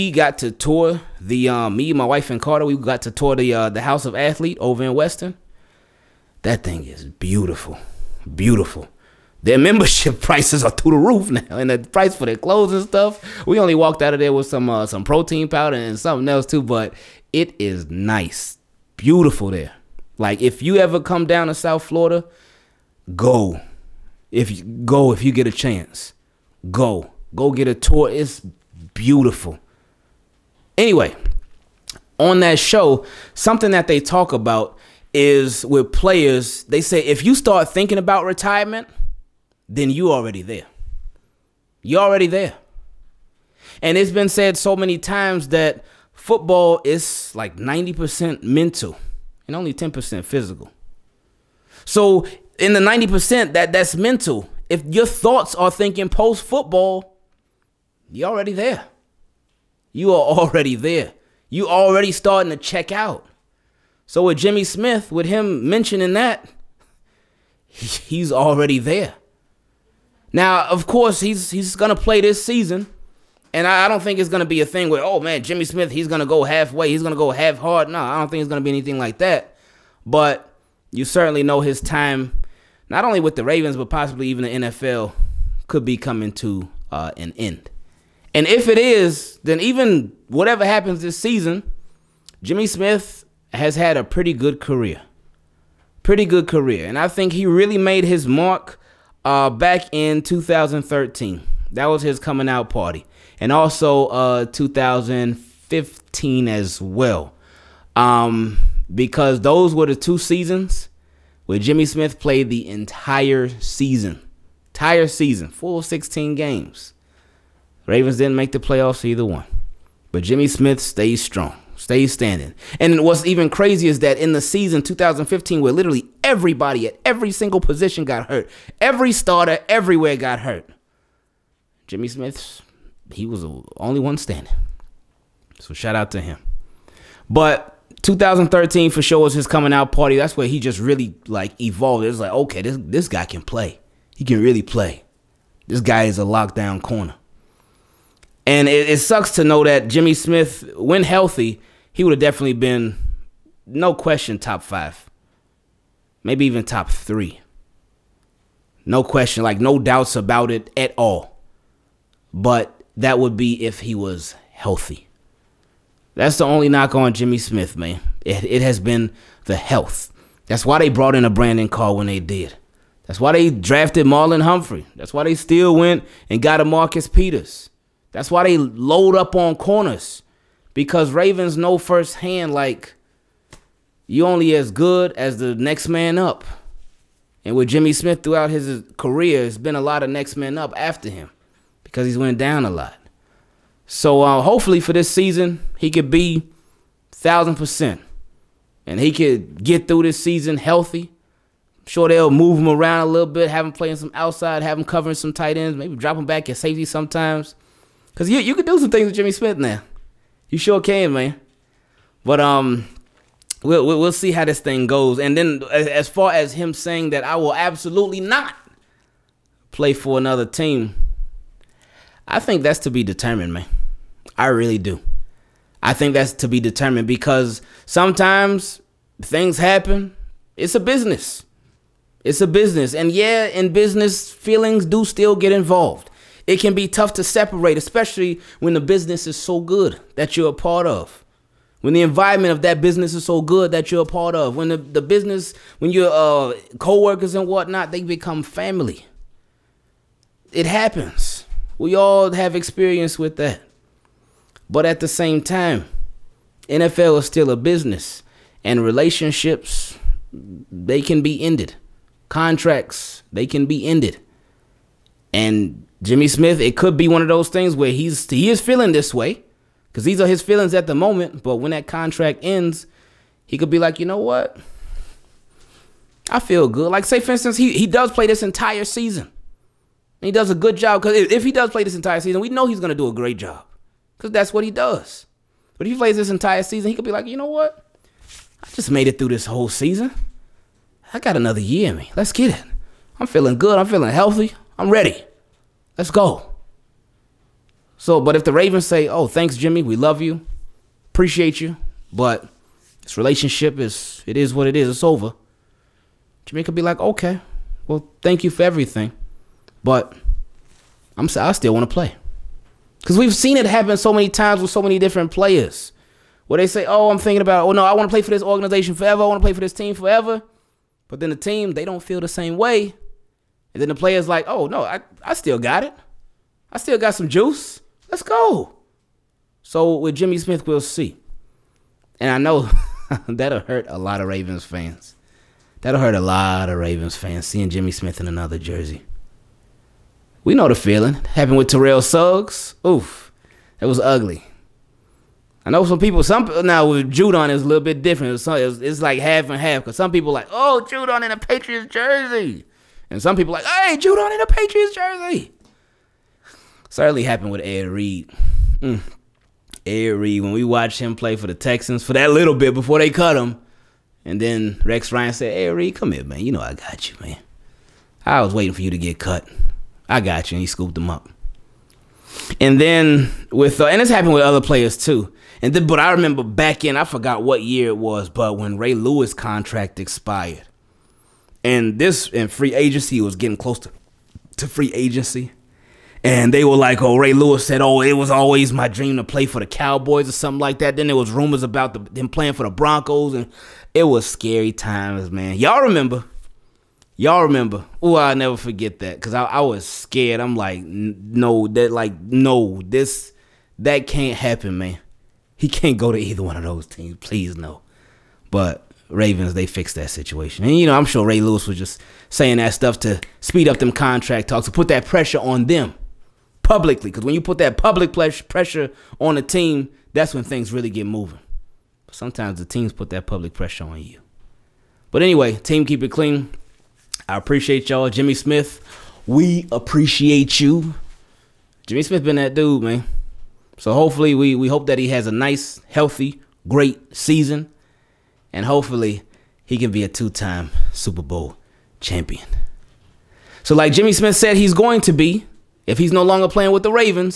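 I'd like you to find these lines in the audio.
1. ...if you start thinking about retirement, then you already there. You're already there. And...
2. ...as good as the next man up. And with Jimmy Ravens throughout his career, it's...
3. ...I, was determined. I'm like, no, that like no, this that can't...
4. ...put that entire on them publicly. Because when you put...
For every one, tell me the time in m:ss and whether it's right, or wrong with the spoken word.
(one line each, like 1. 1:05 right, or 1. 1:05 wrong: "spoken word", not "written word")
1. 0:37 right
2. 3:04 wrong: "Smith", not "Ravens"
3. 6:39 wrong: "scared", not "determined"
4. 6:54 wrong: "pressure", not "entire".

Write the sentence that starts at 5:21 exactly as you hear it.
But then the team, they don't feel the same way.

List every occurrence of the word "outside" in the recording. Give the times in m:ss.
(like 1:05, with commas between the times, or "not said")
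3:24.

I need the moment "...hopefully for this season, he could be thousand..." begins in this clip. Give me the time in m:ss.
3:14.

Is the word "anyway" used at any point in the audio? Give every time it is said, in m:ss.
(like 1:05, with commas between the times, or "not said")
0:30, 7:05.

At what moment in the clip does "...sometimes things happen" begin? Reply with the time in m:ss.
3:47.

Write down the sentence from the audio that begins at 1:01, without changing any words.
You already starting to check out.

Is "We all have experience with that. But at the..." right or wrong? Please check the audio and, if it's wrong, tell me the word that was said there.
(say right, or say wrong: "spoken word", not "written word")
right.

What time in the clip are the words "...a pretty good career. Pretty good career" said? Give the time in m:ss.
1:33.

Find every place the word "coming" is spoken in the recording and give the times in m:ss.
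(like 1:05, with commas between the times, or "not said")
1:25, 1:42, 2:19.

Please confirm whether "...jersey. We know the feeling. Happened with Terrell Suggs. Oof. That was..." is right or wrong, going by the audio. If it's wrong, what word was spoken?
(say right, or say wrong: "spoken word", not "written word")
right.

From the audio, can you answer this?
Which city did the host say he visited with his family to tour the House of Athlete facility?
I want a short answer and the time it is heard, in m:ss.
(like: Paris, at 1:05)
Weston, at 0:04.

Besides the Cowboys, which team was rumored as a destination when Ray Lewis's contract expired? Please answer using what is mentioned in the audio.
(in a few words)
Broncos.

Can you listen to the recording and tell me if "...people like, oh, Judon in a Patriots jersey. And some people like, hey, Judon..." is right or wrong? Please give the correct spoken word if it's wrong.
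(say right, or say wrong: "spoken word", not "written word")
right.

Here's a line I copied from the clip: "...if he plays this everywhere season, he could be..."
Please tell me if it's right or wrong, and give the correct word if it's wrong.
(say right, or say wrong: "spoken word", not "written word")
wrong: "entire", not "everywhere".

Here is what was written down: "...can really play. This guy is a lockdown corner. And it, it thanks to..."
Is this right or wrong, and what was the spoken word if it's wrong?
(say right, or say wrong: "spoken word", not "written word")
wrong: "sucks", not "thanks".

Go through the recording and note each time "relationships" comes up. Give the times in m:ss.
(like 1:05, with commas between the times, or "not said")
4:18, 5:03.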